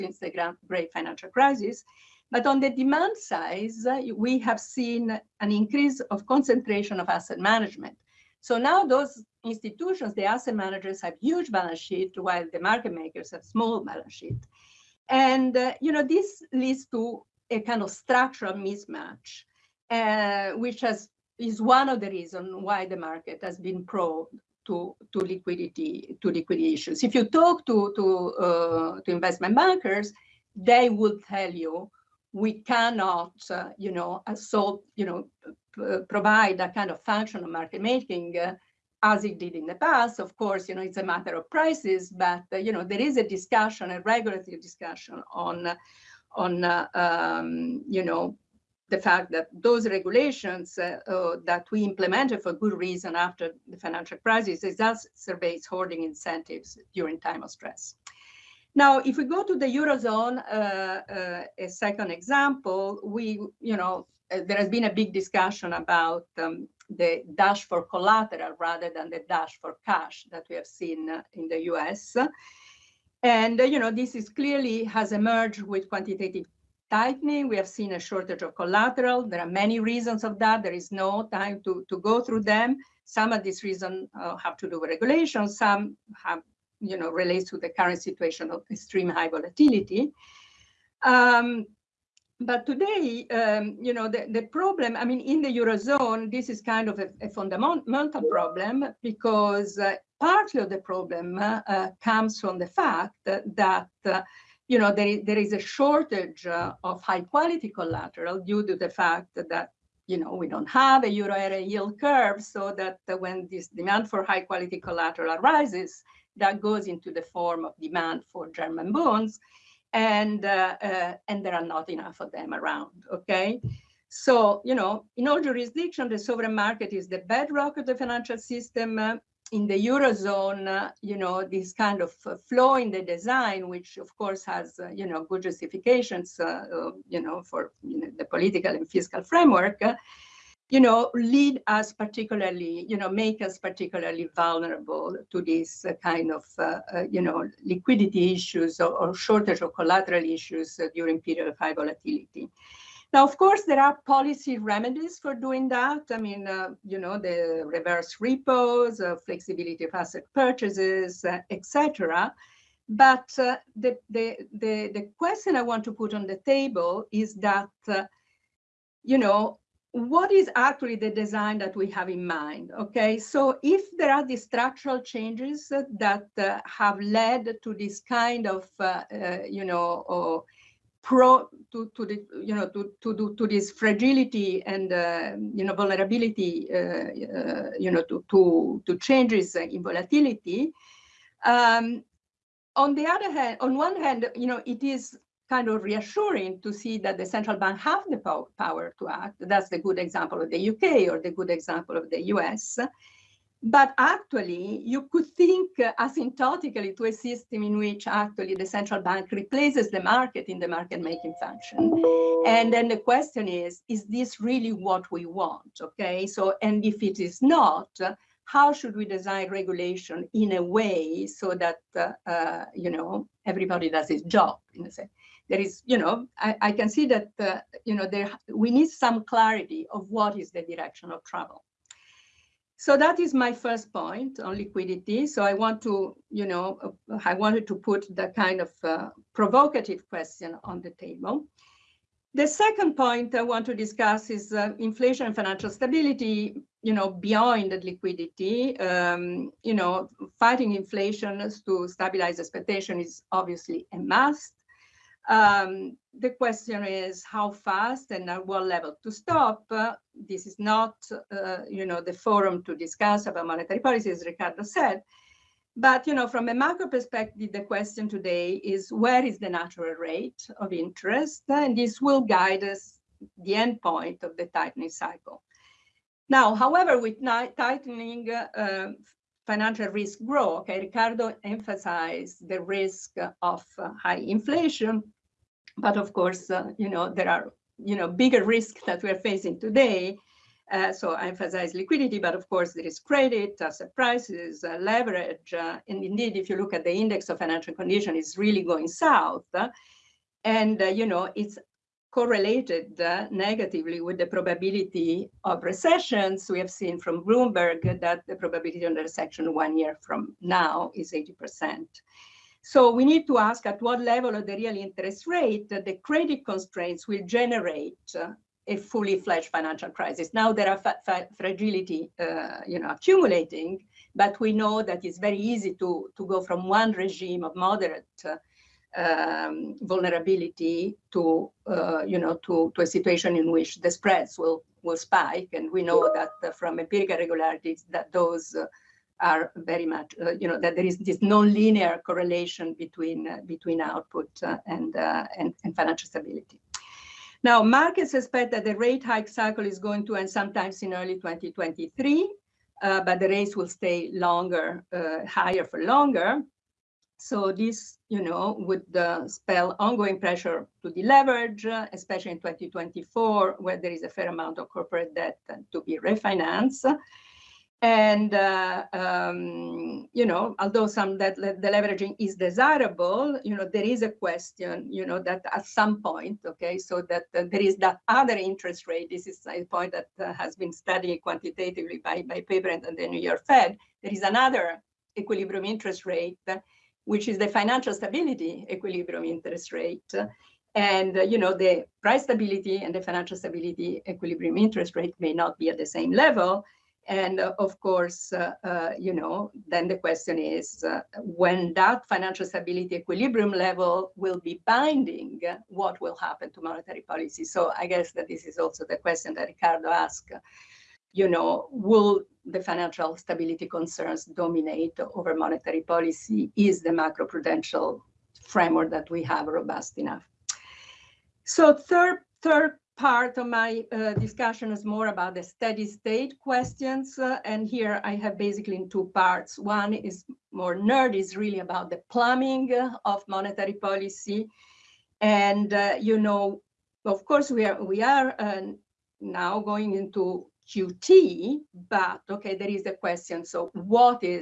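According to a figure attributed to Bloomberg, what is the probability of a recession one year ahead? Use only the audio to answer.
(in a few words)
80%.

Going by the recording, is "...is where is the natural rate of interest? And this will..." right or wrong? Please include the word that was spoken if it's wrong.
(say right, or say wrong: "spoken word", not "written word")
right.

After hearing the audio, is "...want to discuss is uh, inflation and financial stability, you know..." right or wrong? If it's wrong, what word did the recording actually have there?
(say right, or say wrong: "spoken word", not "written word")
right.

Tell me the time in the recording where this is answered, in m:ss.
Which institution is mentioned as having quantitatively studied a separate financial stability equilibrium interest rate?
6:22.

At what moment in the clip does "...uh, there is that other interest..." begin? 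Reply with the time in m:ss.
6:17.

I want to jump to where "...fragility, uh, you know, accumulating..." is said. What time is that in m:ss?
5:21.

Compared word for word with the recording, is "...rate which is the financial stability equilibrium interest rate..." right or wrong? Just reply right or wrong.
right.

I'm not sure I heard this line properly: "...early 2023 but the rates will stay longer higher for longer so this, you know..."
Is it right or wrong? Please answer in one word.
right.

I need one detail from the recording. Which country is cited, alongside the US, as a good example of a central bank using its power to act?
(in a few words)
UK.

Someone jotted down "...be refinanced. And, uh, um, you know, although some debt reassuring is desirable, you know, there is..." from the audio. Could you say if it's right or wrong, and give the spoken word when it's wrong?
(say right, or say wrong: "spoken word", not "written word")
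wrong: "deleveraging", not "reassuring".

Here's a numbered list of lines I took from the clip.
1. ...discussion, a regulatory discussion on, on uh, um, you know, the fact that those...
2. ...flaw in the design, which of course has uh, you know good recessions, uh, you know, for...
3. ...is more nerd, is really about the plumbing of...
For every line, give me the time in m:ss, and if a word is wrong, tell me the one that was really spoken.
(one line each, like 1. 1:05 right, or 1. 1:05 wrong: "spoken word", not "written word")
1. 0:43 right
2. 2:12 wrong: "justifications", not "recessions"
3. 7:09 right.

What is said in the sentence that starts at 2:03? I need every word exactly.
Okay, so you know, in all jurisdictions, the sovereign market is the bedrock of the financial system.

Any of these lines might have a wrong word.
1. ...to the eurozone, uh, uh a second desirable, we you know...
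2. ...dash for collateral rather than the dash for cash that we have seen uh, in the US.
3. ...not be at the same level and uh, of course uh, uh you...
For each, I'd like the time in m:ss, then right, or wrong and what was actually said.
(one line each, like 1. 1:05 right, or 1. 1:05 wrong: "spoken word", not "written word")
1. 0:59 wrong: "example", not "desirable"
2. 1:07 right
3. 6:35 right.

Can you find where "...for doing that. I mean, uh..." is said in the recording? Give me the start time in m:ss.
2:35.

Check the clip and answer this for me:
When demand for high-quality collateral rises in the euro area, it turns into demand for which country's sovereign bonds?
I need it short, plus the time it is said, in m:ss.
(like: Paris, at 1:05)
German bonds, at 1:58.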